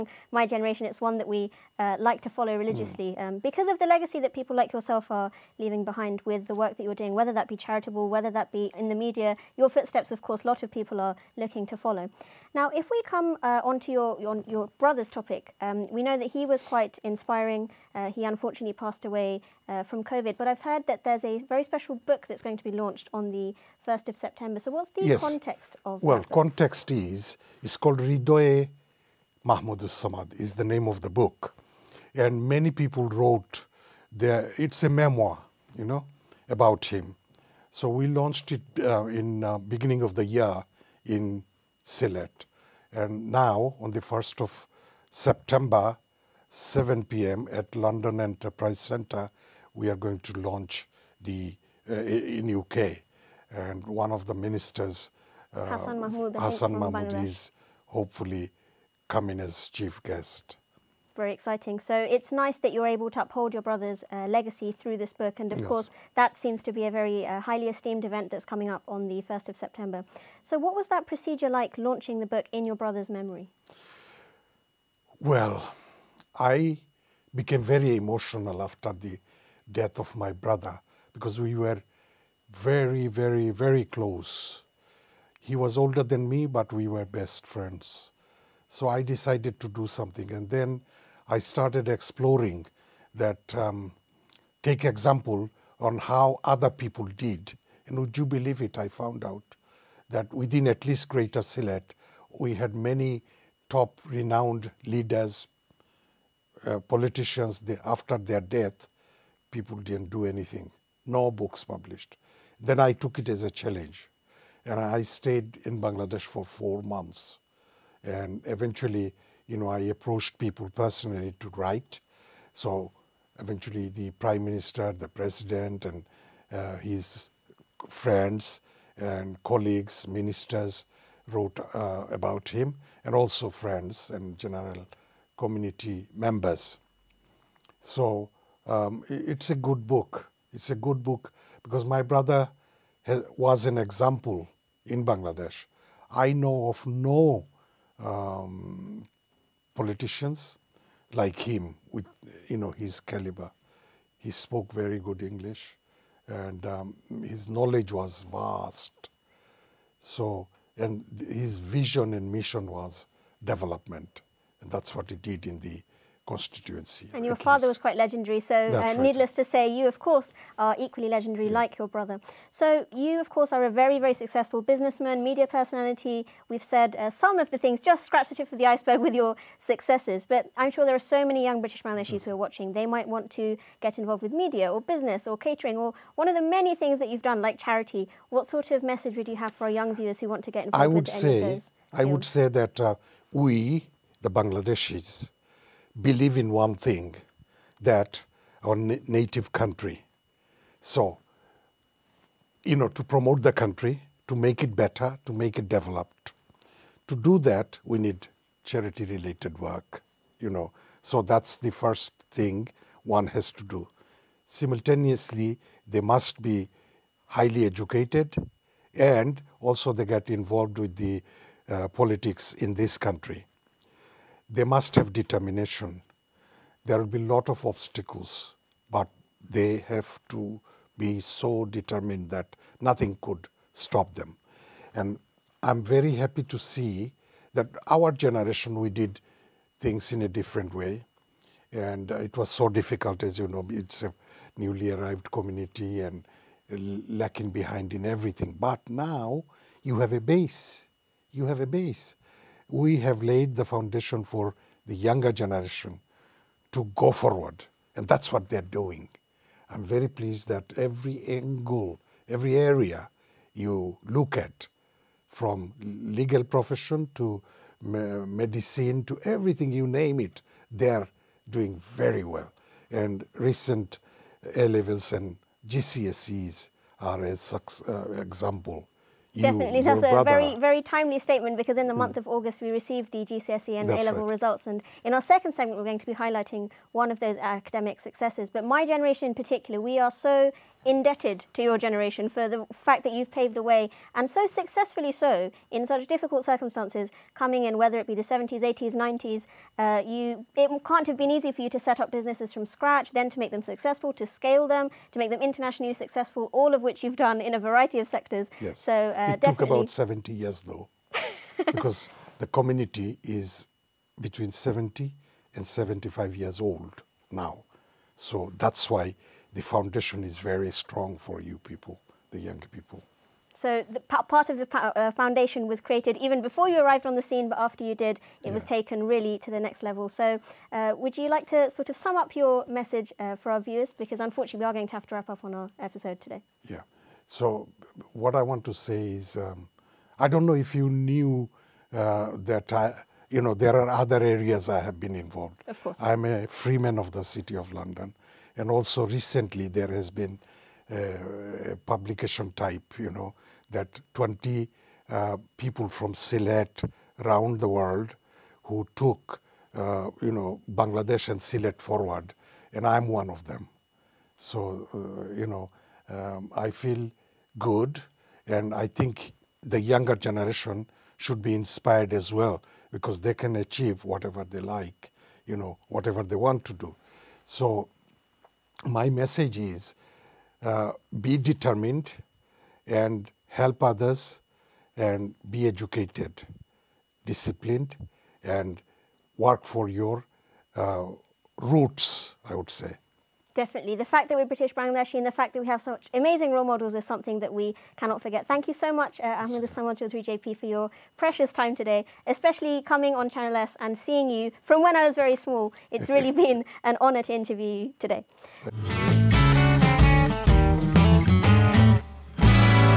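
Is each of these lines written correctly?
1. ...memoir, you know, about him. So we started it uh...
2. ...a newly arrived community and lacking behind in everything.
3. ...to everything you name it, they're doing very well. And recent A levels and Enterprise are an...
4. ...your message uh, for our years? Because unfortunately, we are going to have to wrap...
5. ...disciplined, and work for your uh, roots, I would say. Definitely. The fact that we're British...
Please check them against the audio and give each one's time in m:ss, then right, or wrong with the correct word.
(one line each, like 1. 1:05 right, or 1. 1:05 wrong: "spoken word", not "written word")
1. 0:34 wrong: "launched", not "started"
2. 4:04 right
3. 4:29 wrong: "GCSEs", not "Enterprise"
4. 5:32 wrong: "viewers", not "years"
5. 6:27 right.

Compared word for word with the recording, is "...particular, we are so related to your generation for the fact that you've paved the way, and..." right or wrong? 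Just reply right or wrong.
wrong.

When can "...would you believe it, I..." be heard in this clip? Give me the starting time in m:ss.
1:37.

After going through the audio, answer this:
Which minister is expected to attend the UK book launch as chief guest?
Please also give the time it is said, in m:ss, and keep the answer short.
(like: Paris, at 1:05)
Hassan Mahmoud, at 0:55.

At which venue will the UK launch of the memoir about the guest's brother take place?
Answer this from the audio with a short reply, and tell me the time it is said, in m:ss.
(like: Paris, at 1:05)
London Enterprise Center, at 0:47.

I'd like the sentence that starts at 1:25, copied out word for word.
He was older than me, but we were best friends.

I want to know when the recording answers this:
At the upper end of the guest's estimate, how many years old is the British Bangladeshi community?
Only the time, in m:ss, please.
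5:15.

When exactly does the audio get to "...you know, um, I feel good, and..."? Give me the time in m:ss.
6:05.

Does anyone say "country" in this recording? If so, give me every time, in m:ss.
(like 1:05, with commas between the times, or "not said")
3:19, 3:23, 3:42.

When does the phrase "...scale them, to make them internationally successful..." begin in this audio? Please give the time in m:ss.
5:04.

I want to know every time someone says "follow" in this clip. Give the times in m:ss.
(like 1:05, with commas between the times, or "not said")
0:02, 0:11.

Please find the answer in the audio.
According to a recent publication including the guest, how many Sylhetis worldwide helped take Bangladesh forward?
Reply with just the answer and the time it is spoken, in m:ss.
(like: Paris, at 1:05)
20, at 5:54.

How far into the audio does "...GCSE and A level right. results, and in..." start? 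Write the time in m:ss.
4:43.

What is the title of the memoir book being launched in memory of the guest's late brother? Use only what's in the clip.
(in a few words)
Ridoe Mahmoud Samad.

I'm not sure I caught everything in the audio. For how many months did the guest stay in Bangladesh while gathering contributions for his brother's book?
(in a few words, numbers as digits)
4.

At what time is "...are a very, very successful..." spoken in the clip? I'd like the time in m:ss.
2:53.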